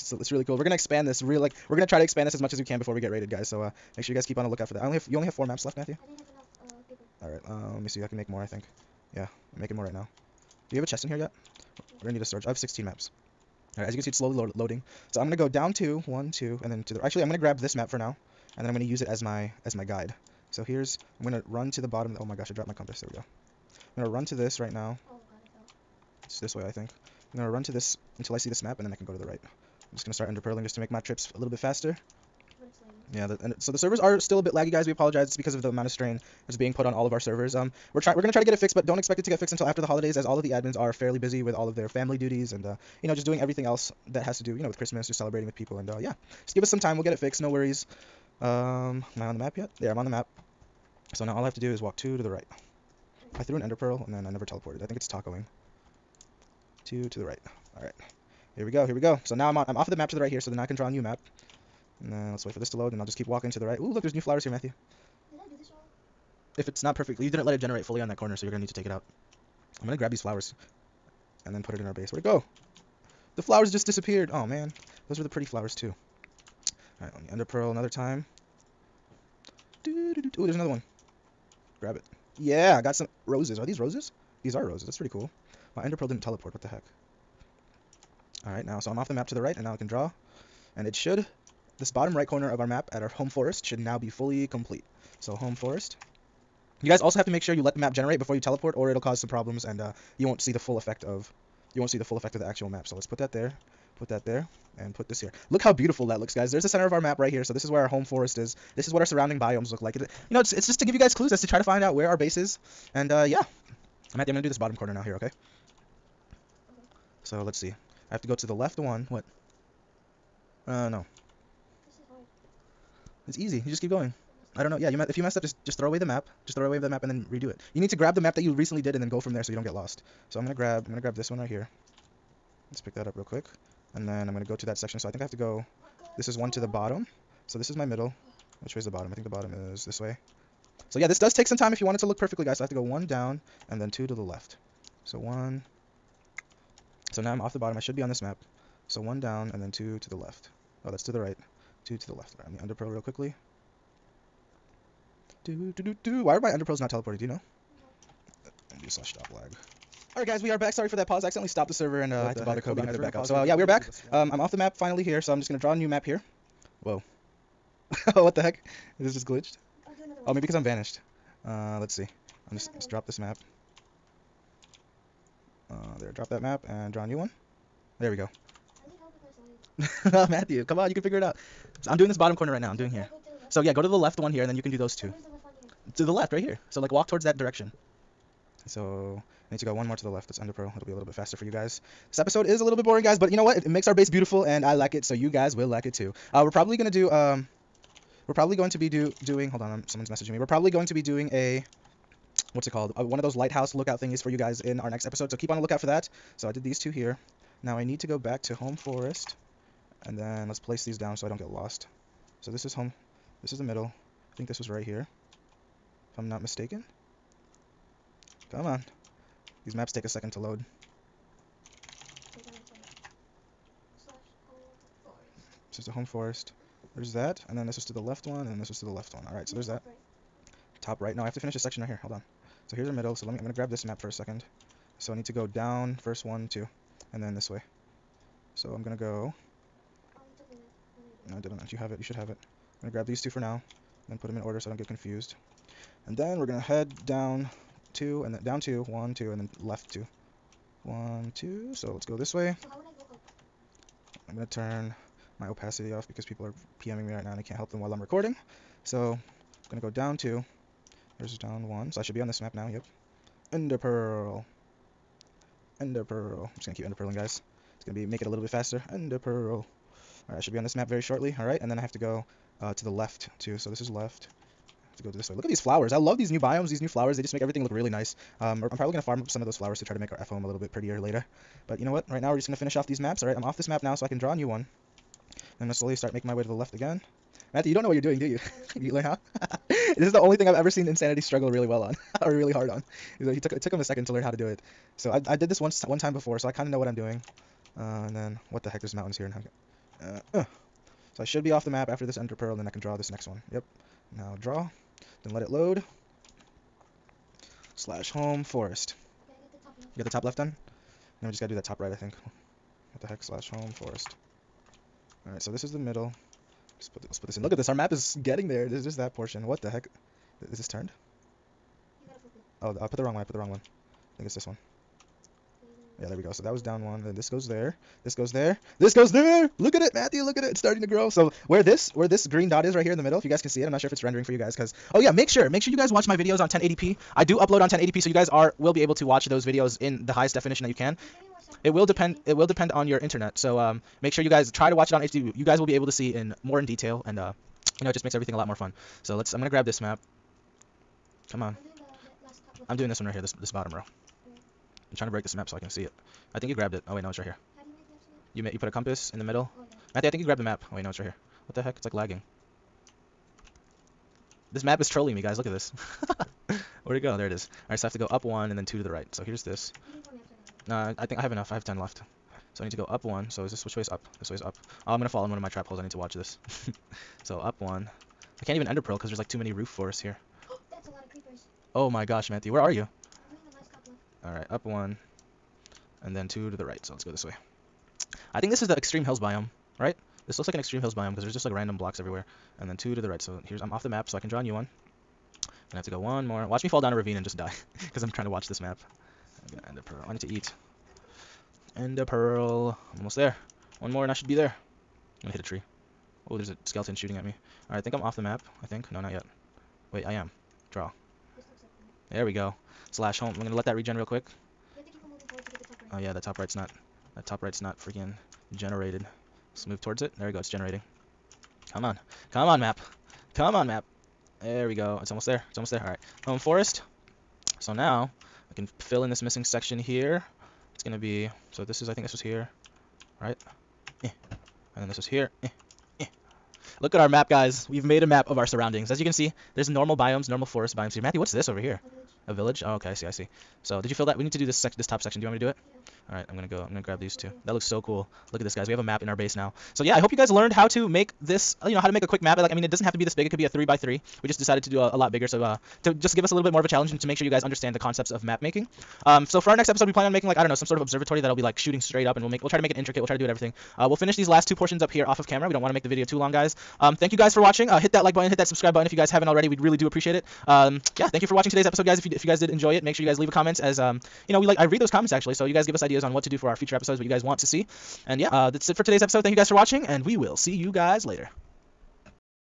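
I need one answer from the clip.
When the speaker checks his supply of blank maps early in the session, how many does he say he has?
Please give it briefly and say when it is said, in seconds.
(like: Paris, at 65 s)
16, at 12 s.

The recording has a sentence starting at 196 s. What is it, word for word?
Uh, we're probably gonna do um, we're probably going to be do doing.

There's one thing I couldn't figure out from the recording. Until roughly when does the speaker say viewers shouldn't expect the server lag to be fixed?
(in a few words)
After the holidays.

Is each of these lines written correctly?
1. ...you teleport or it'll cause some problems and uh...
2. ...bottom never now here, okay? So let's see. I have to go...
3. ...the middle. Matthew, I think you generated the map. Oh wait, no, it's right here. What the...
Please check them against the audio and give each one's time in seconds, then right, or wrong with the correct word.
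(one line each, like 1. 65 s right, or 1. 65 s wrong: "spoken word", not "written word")
1. 98 s right
2. 114 s wrong: "corner", not "never"
3. 359 s wrong: "grabbed", not "generated".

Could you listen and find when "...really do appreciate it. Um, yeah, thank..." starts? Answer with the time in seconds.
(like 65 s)
469 s.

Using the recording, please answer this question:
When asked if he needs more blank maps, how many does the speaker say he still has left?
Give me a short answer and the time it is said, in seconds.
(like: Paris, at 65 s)
10, at 371 s.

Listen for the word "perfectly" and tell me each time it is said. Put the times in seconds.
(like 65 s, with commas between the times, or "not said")
66 s, 142 s.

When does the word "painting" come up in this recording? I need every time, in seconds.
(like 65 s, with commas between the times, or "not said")
not said.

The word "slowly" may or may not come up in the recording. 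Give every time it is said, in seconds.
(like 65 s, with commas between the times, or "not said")
14 s, 285 s.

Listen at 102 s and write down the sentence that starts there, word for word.
So let's put that there, put that there, and put this here.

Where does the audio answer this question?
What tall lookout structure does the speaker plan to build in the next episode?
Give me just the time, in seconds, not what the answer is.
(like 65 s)
203 s.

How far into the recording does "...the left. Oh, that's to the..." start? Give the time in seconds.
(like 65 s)
150 s.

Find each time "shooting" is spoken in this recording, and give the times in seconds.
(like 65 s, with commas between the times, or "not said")
406 s, 461 s.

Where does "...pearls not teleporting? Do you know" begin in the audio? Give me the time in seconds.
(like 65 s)
156 s.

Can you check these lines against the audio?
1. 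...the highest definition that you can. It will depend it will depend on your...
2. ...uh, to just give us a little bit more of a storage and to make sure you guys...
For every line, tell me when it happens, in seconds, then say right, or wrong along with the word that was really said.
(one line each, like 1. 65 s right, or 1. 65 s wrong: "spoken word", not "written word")
1. 340 s right
2. 455 s wrong: "challenge", not "storage".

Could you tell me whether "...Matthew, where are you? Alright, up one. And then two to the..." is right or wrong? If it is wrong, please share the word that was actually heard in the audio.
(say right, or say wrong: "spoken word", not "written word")
right.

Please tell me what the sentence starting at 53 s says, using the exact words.
I threw an ender pearl and then I never teleported.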